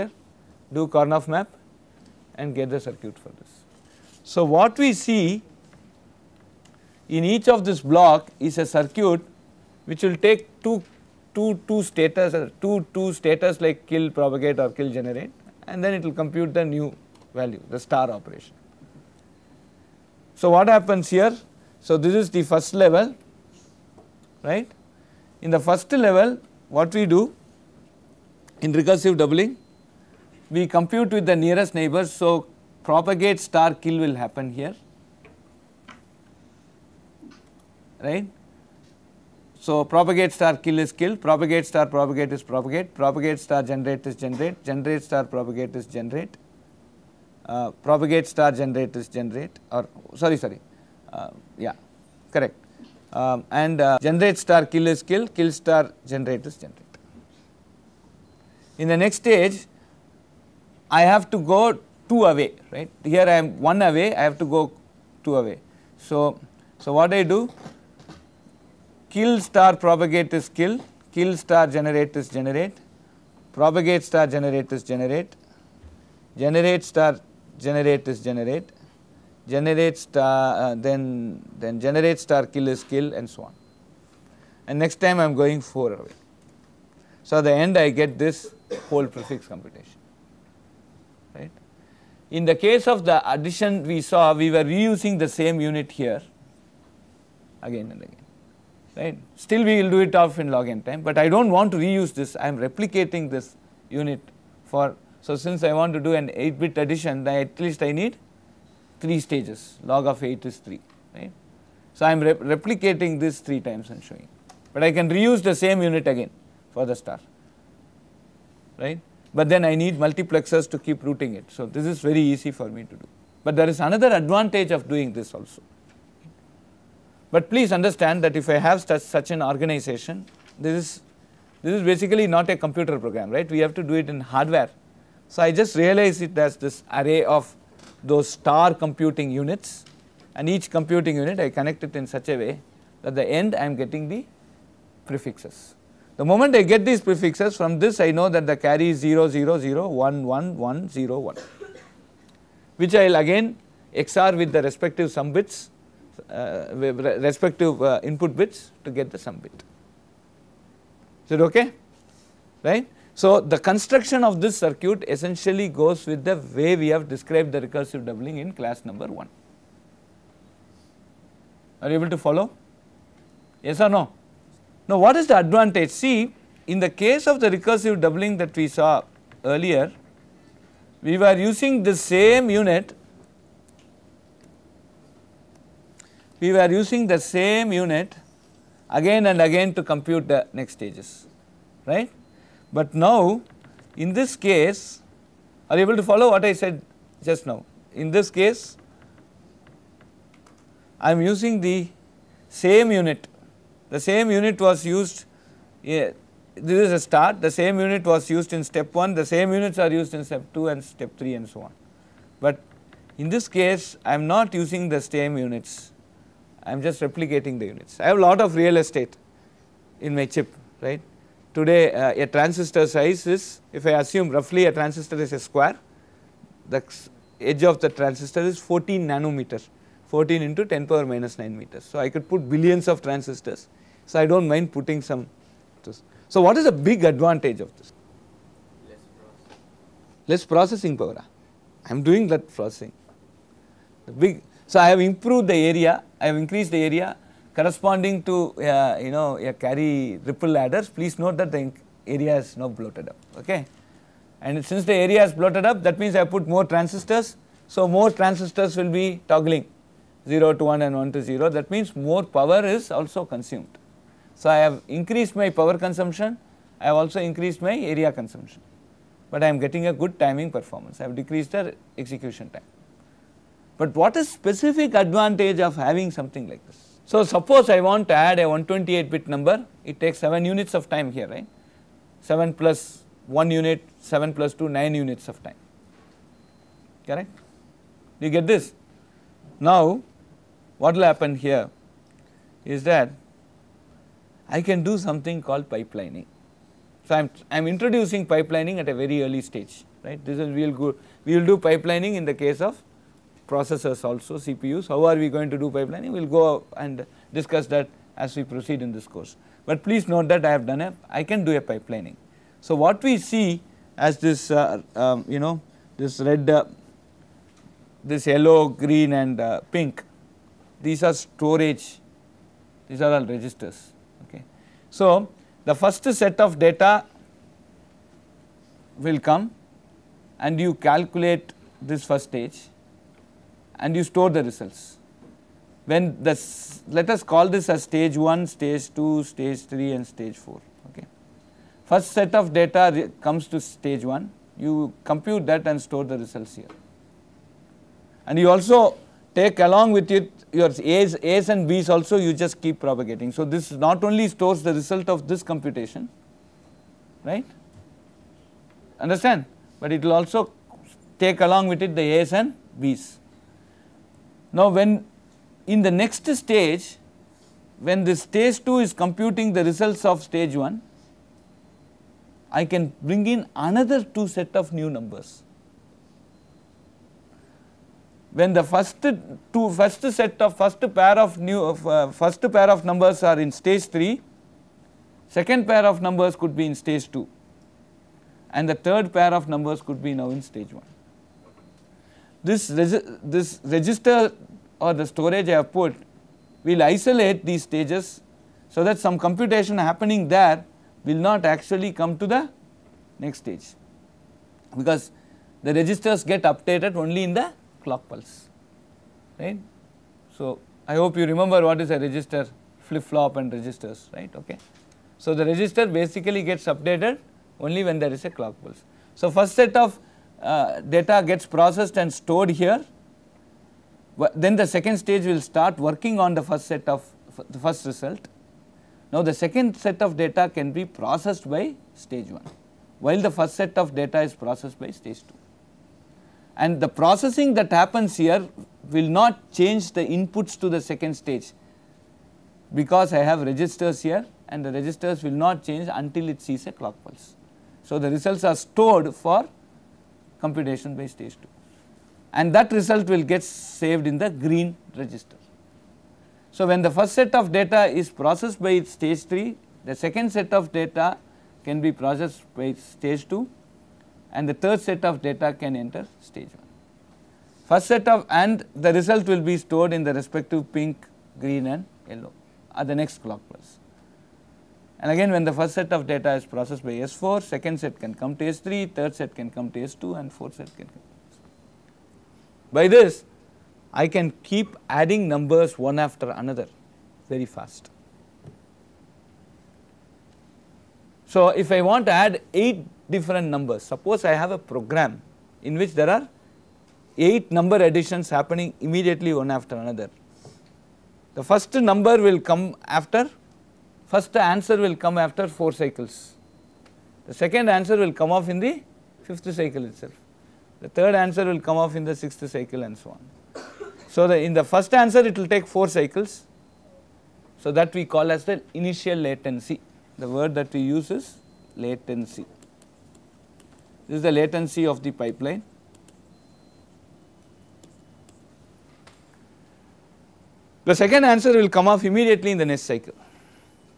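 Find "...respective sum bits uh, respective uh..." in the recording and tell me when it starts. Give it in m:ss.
2:34.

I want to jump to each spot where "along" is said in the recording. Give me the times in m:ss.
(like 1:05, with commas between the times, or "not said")
5:49, 6:01.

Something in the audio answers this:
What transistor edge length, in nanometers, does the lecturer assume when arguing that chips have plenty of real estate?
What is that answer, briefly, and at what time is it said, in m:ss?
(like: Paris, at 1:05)
14 nanometers, at 3:48.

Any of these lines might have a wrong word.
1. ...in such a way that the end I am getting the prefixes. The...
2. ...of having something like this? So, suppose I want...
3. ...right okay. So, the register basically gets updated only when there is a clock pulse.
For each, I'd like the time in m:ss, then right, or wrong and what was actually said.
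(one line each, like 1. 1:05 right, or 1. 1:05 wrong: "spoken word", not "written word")
1. 2:21 right
2. 4:35 right
3. 6:54 right.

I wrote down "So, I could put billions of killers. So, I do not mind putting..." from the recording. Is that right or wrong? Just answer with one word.
wrong.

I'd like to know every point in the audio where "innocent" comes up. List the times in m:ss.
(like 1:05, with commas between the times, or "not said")
not said.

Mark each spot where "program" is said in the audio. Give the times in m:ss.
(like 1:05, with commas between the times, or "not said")
2:12, 8:14.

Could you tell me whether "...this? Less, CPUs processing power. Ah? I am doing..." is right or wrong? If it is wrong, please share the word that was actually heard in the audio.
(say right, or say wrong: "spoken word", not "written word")
wrong: "Less", not "CPUs".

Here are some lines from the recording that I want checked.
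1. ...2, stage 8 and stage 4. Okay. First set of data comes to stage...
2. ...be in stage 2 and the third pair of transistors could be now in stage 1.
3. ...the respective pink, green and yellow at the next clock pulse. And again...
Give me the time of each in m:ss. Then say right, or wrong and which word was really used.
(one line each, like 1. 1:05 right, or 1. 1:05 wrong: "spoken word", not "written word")
1. 5:38 wrong: "3", not "8"
2. 6:26 wrong: "numbers", not "transistors"
3. 7:50 right.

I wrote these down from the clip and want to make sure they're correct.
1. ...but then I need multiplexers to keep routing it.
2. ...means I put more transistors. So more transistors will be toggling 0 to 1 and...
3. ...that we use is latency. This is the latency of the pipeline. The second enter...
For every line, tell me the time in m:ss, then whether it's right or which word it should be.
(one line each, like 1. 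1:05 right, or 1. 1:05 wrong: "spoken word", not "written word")
1. 1:59 right
2. 4:15 right
3. 8:40 wrong: "answer", not "enter".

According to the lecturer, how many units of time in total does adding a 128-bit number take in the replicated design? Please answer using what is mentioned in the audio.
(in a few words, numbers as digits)
9.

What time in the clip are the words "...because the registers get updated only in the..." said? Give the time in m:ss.
6:44.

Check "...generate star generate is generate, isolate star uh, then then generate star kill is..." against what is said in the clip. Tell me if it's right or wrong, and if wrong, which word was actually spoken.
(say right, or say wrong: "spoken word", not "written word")
wrong: "generate", not "isolate".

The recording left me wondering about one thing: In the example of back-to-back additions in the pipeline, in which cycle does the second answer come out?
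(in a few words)
fifth cycle.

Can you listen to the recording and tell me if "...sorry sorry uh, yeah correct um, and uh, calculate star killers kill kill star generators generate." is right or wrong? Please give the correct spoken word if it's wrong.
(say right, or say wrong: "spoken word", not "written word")
wrong: "generate", not "calculate".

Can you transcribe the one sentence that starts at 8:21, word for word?
The first number will come after first answer will come after 4 cycles.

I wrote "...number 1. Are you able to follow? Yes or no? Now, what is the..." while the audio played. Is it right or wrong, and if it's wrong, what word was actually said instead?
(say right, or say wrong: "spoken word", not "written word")
right.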